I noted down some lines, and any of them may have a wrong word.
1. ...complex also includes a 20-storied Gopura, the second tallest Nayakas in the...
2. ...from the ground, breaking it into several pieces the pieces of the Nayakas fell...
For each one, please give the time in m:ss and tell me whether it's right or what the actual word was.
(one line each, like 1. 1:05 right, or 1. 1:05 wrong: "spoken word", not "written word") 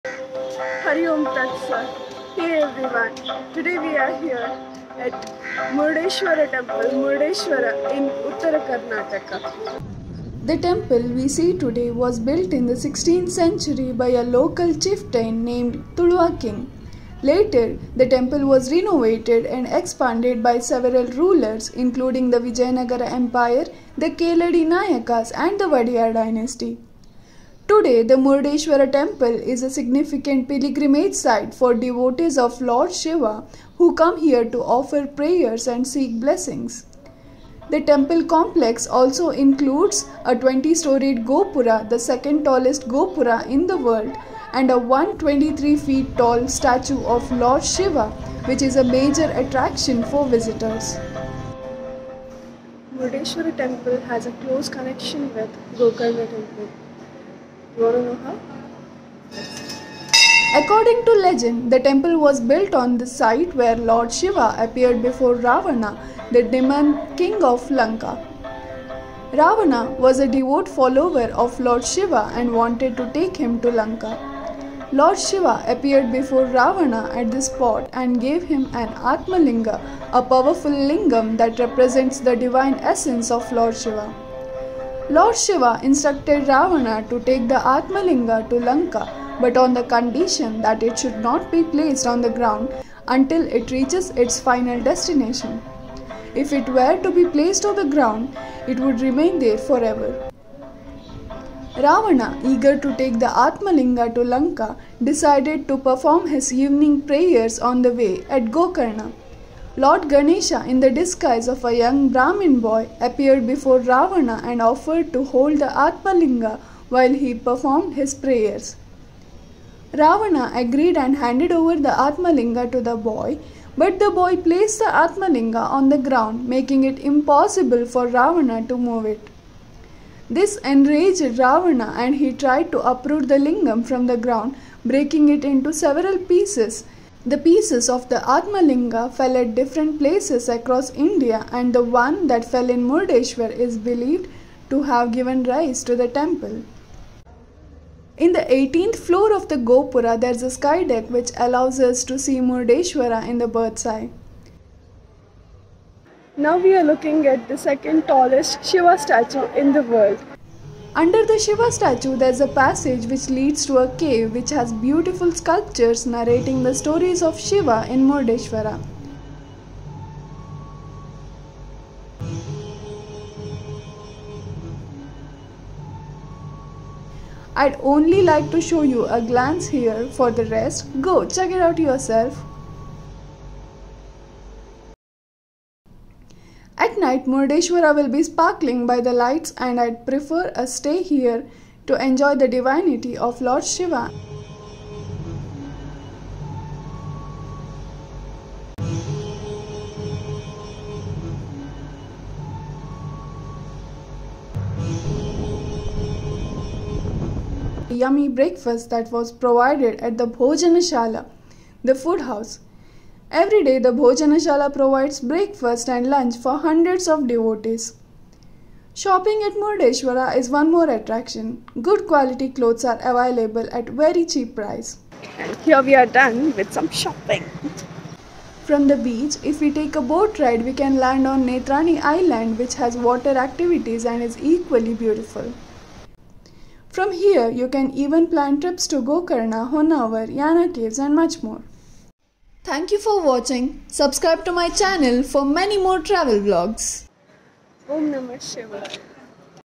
1. 0:38 wrong: "Gopura", not "Nayakas"
2. 2:13 wrong: "Atmalinga", not "Nayakas".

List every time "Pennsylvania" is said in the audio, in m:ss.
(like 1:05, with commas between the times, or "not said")
not said.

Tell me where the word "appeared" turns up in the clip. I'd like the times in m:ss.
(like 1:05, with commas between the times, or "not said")
1:04, 1:15, 1:52.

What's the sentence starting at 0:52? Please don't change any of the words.
Murdeshwara temple has a close connection with Gokarna temple.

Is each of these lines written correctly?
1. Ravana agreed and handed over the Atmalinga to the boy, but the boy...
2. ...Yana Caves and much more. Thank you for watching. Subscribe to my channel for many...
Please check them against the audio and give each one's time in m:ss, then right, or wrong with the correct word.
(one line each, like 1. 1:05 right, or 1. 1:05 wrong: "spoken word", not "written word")
1. 1:59 right
2. 4:00 right.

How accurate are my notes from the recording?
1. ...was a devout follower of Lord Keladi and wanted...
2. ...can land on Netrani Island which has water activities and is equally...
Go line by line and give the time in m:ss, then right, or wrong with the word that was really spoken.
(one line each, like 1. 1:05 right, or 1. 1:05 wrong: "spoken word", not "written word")
1. 1:09 wrong: "Shiva", not "Keladi"
2. 3:50 right.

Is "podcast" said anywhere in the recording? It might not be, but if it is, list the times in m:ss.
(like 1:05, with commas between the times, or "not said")
not said.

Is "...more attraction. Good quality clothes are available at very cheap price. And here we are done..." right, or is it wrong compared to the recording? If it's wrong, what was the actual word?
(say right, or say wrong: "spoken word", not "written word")
right.